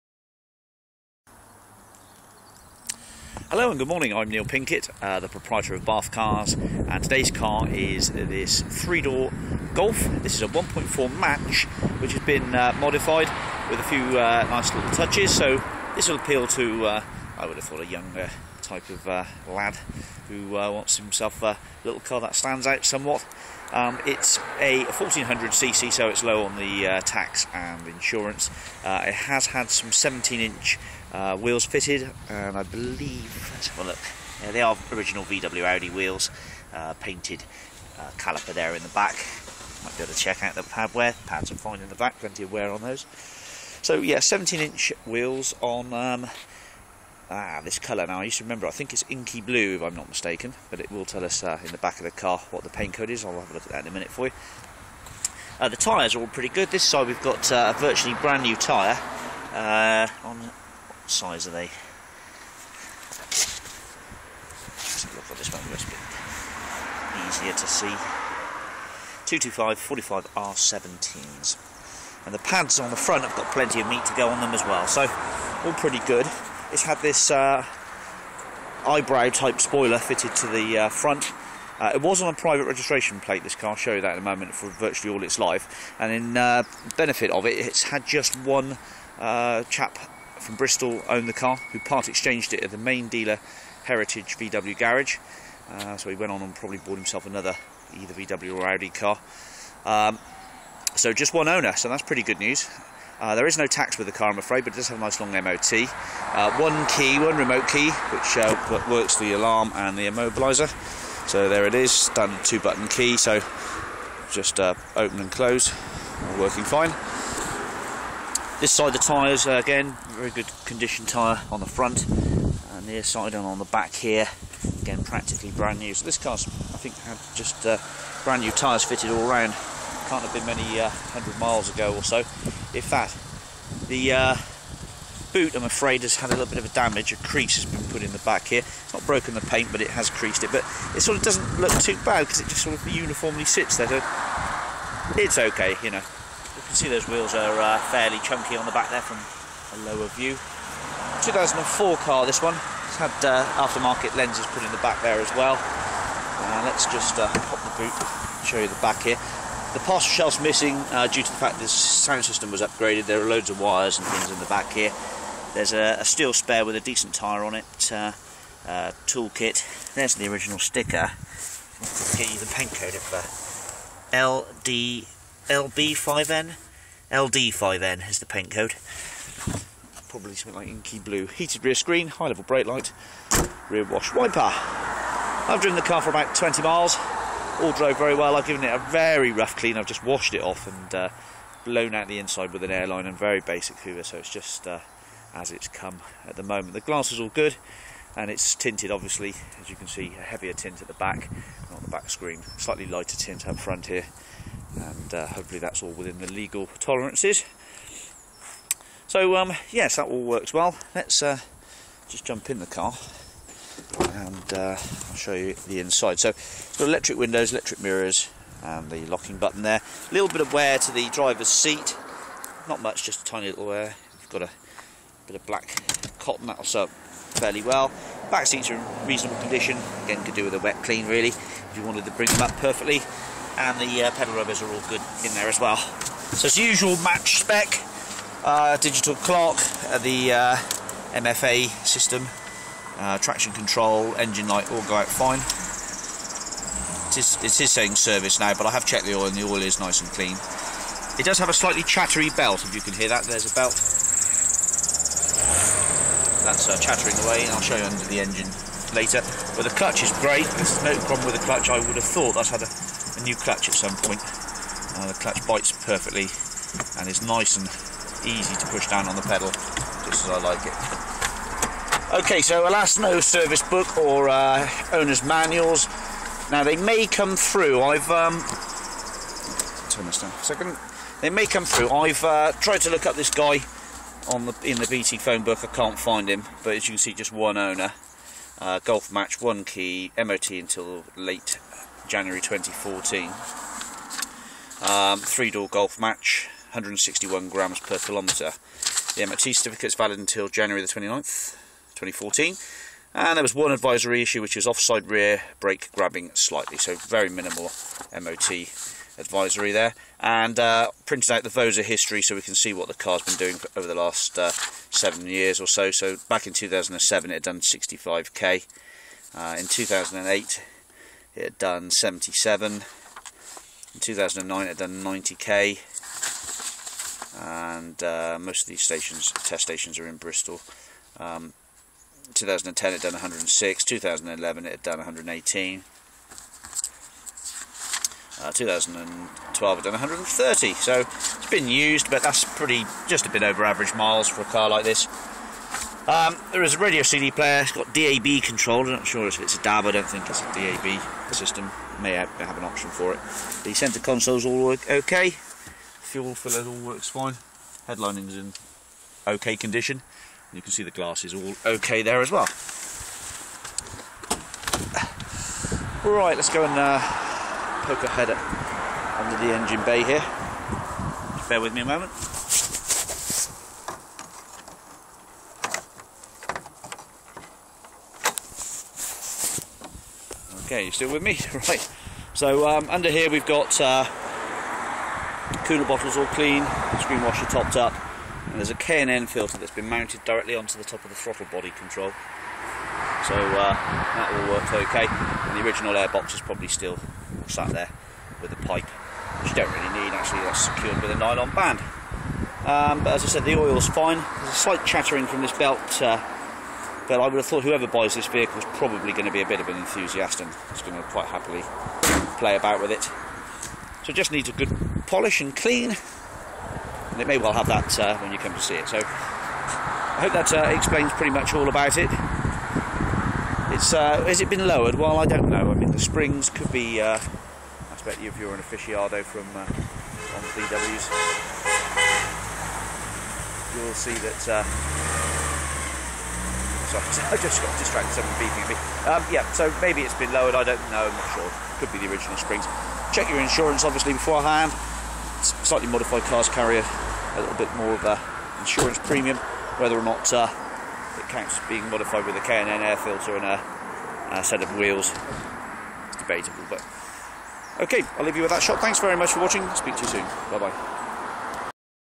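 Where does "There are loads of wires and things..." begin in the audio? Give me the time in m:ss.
2:43.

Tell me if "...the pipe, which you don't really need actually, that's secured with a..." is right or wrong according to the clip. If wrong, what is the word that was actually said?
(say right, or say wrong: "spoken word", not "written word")
right.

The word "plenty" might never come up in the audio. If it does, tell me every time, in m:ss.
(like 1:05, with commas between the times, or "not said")
0:42, 1:13.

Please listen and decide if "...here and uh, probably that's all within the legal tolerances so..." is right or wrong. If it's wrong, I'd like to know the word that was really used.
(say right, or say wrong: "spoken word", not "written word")
wrong: "hopefully", not "probably".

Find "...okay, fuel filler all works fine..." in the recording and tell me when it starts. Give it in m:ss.
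5:54.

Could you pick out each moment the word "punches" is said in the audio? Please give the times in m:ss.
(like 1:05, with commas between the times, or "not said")
not said.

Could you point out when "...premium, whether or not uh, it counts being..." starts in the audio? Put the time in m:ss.
7:28.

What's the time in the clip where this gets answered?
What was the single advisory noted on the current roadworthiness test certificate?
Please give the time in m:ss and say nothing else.
5:04.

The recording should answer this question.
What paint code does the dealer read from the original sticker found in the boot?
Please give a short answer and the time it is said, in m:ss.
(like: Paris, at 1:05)
LD5N, at 2:57.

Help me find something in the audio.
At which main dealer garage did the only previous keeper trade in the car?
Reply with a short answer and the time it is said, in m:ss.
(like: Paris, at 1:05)
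Heritage VW, at 1:33.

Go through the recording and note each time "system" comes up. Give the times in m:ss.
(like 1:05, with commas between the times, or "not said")
2:42, 4:01, 5:51.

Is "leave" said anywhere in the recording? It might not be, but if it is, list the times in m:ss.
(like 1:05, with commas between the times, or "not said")
7:38.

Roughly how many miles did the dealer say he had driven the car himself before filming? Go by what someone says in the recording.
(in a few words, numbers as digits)
20.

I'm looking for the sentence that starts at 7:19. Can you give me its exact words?
Um, yeah, so maybe it's been lowered.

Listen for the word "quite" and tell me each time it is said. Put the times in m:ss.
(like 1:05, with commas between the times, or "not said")
6:51.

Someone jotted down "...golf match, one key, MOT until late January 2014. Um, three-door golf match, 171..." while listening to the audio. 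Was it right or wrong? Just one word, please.
wrong.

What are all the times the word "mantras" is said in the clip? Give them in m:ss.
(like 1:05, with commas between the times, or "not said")
not said.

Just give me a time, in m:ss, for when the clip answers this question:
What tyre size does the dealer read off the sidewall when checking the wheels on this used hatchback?
1:09.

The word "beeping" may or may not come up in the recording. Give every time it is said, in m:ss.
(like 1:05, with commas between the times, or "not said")
7:18.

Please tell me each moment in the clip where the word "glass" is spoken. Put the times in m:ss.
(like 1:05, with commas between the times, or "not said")
3:16, 6:00.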